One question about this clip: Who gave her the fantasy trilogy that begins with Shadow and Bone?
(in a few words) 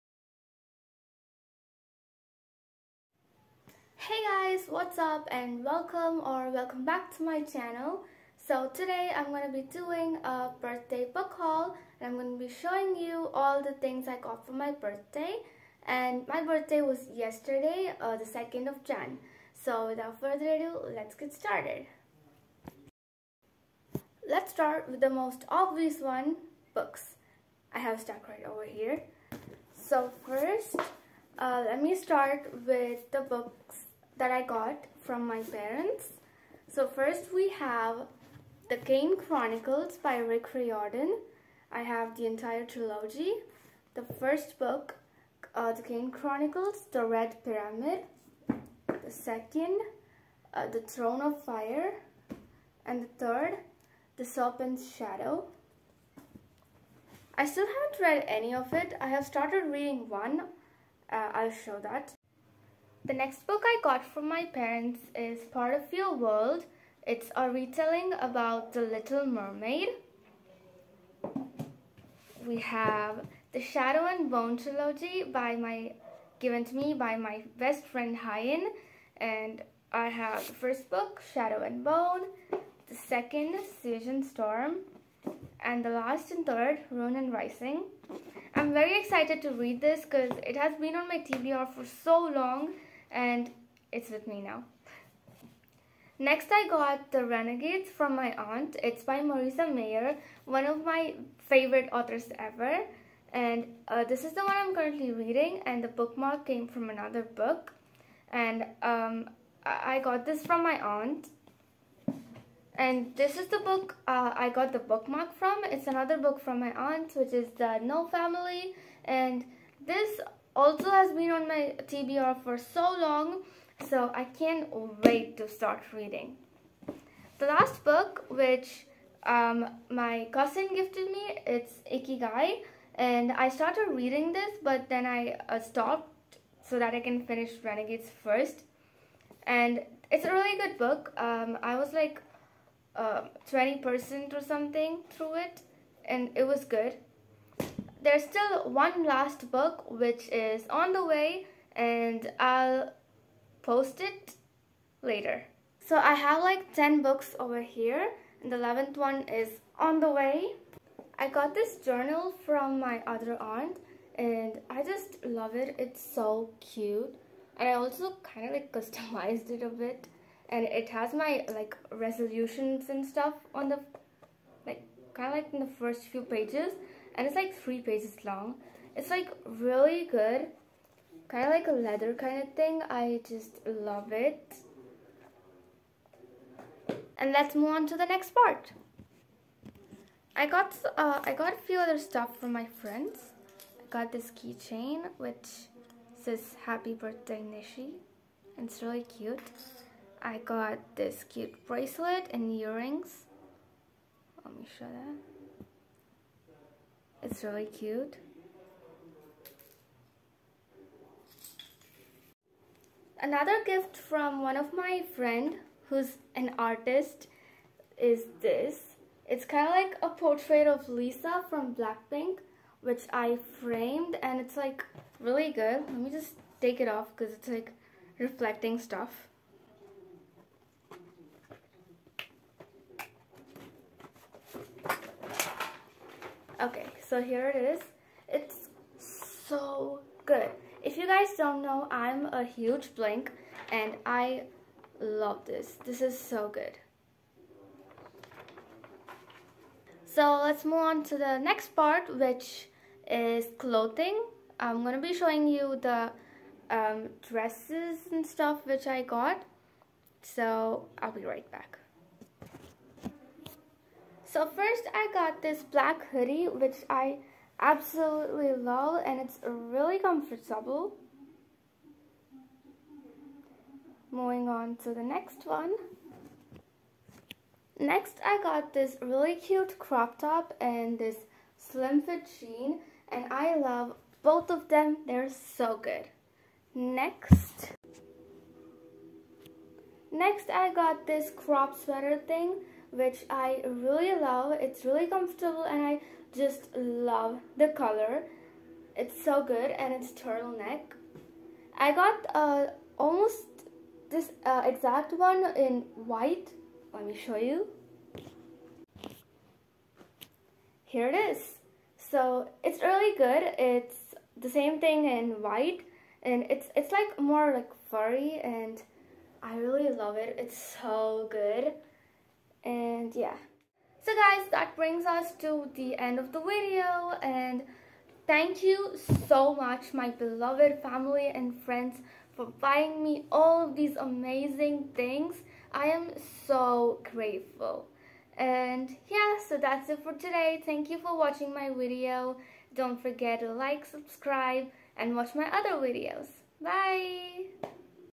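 Hyun.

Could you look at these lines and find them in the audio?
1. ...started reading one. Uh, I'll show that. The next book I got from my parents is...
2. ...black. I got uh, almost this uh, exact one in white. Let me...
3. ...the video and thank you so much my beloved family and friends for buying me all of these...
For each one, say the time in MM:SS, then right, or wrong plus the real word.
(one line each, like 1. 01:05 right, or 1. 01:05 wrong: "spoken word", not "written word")
1. 00:59 right
2. 05:00 wrong: "turtleneck", not "black"
3. 05:26 right.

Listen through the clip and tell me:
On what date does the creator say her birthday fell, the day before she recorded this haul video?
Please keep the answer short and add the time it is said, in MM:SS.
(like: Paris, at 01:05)
2nd of January, at 00:18.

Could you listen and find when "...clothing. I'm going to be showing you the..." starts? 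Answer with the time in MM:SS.
04:13.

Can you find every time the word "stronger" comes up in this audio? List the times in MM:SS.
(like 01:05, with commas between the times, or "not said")
not said.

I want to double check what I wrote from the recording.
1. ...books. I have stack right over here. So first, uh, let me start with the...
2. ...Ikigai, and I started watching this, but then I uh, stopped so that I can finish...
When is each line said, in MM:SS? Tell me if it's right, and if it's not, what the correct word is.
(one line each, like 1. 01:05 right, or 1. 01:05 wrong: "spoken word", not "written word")
1. 00:26 right
2. 02:11 wrong: "reading", not "watching".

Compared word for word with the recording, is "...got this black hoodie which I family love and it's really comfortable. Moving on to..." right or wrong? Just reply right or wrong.
wrong.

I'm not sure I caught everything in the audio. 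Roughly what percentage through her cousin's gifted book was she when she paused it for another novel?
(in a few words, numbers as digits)
20%.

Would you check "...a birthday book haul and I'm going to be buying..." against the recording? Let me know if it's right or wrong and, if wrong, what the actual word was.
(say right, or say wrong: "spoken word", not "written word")
wrong: "showing", not "buying".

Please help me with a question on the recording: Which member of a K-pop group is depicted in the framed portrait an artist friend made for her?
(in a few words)
Lisa.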